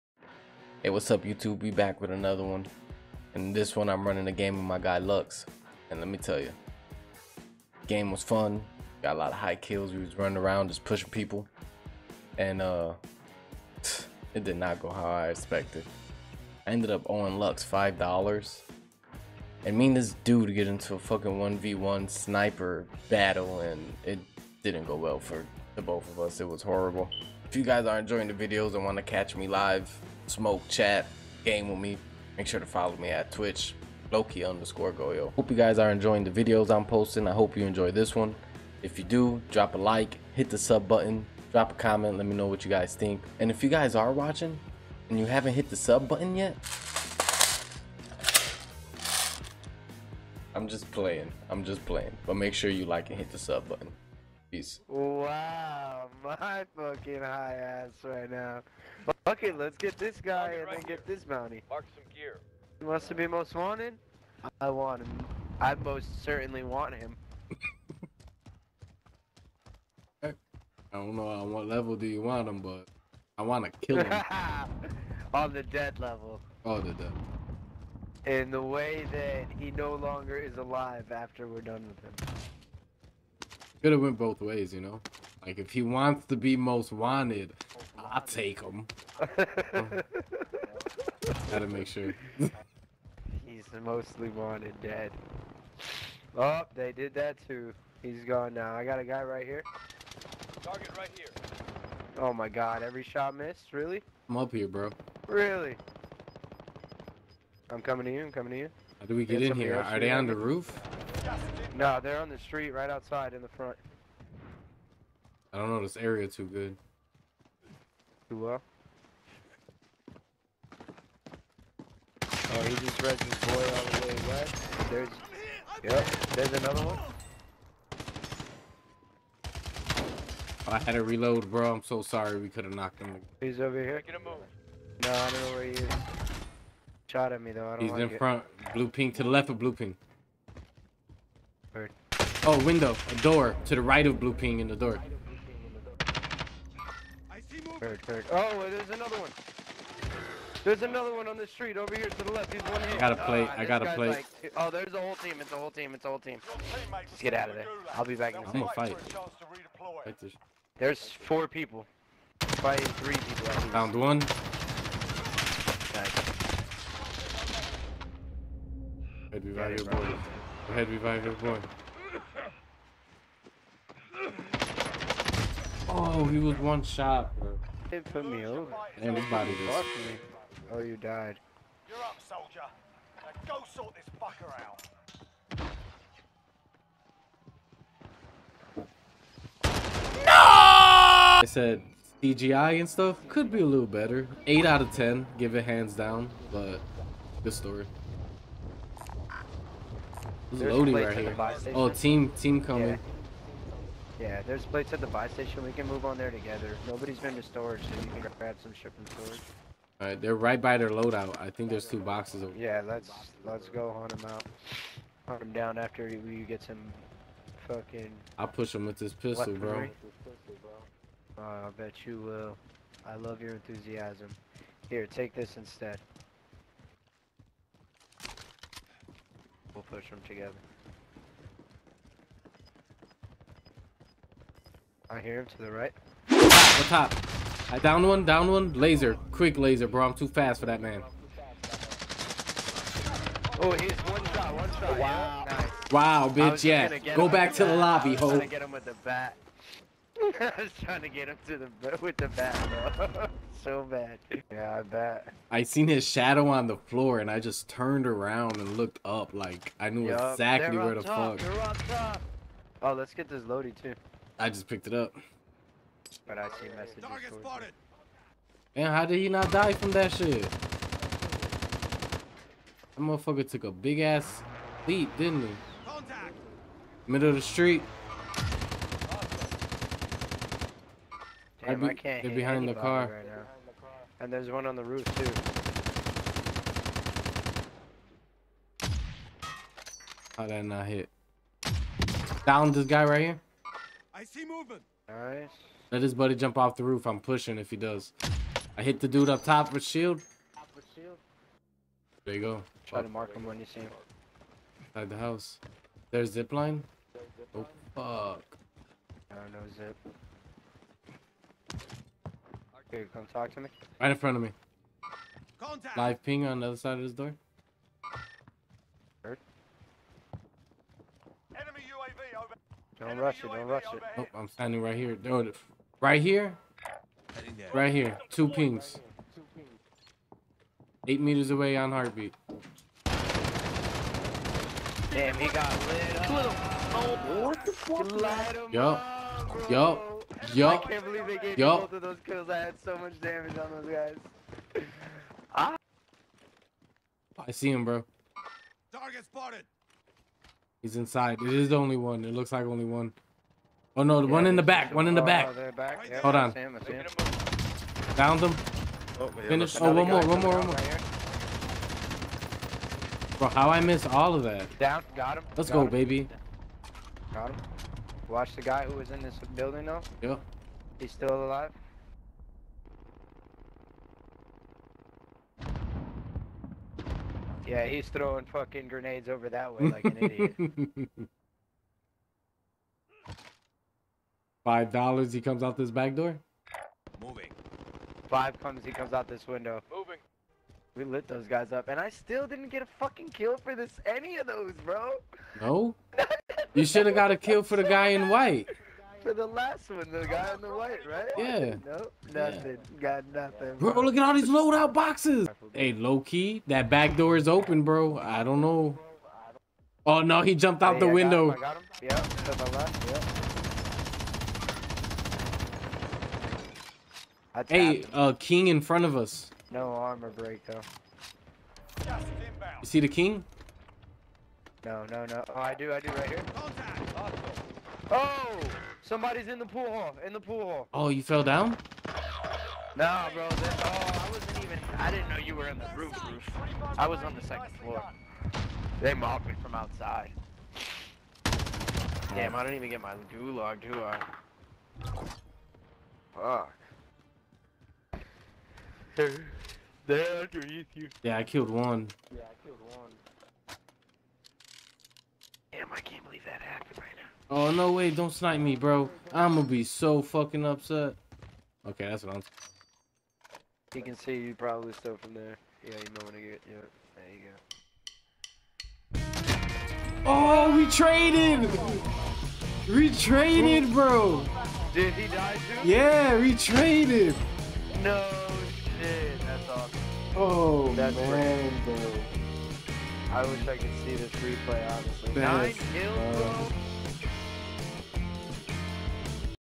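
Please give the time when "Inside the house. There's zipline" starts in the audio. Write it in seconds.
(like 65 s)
304 s.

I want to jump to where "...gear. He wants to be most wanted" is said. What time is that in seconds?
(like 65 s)
62 s.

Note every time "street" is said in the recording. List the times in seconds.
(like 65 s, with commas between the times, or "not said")
112 s, 151 s, 277 s.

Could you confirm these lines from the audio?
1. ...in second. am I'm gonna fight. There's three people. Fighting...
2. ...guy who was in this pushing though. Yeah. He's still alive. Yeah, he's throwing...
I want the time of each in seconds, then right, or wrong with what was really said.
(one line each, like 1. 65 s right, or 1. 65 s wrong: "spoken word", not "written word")
1. 158 s wrong: "four", not "three"
2. 368 s wrong: "building", not "pushing".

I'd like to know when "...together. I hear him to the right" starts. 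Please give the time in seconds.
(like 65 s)
230 s.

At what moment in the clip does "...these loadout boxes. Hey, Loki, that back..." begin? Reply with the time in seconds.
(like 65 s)
404 s.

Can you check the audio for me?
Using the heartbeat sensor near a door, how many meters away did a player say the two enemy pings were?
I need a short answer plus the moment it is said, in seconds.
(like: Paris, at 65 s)
8, at 331 s.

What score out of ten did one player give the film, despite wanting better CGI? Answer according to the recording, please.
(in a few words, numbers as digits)
8.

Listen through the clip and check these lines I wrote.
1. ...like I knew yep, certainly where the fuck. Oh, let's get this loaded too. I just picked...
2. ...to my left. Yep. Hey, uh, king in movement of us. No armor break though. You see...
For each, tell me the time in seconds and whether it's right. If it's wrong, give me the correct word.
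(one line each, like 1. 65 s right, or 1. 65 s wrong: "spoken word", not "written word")
1. 259 s wrong: "exactly", not "certainly"
2. 412 s wrong: "front", not "movement".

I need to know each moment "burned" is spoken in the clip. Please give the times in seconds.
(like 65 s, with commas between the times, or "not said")
not said.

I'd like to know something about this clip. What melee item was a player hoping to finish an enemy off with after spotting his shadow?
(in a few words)
bat.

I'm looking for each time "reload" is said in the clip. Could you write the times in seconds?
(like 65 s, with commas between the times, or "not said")
131 s.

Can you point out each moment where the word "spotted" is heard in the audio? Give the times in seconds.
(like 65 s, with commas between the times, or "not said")
267 s, 349 s.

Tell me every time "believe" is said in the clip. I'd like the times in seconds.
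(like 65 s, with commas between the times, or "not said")
341 s, 456 s.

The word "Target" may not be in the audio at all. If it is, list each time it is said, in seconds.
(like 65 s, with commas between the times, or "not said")
100 s, 267 s, 348 s.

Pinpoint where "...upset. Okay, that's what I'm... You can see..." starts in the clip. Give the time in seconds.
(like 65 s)
460 s.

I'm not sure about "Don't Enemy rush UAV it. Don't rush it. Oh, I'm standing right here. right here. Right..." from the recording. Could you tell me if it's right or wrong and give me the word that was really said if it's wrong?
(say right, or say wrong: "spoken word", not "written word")
right.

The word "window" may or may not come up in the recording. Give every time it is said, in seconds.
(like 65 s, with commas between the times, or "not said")
142 s, 389 s, 411 s.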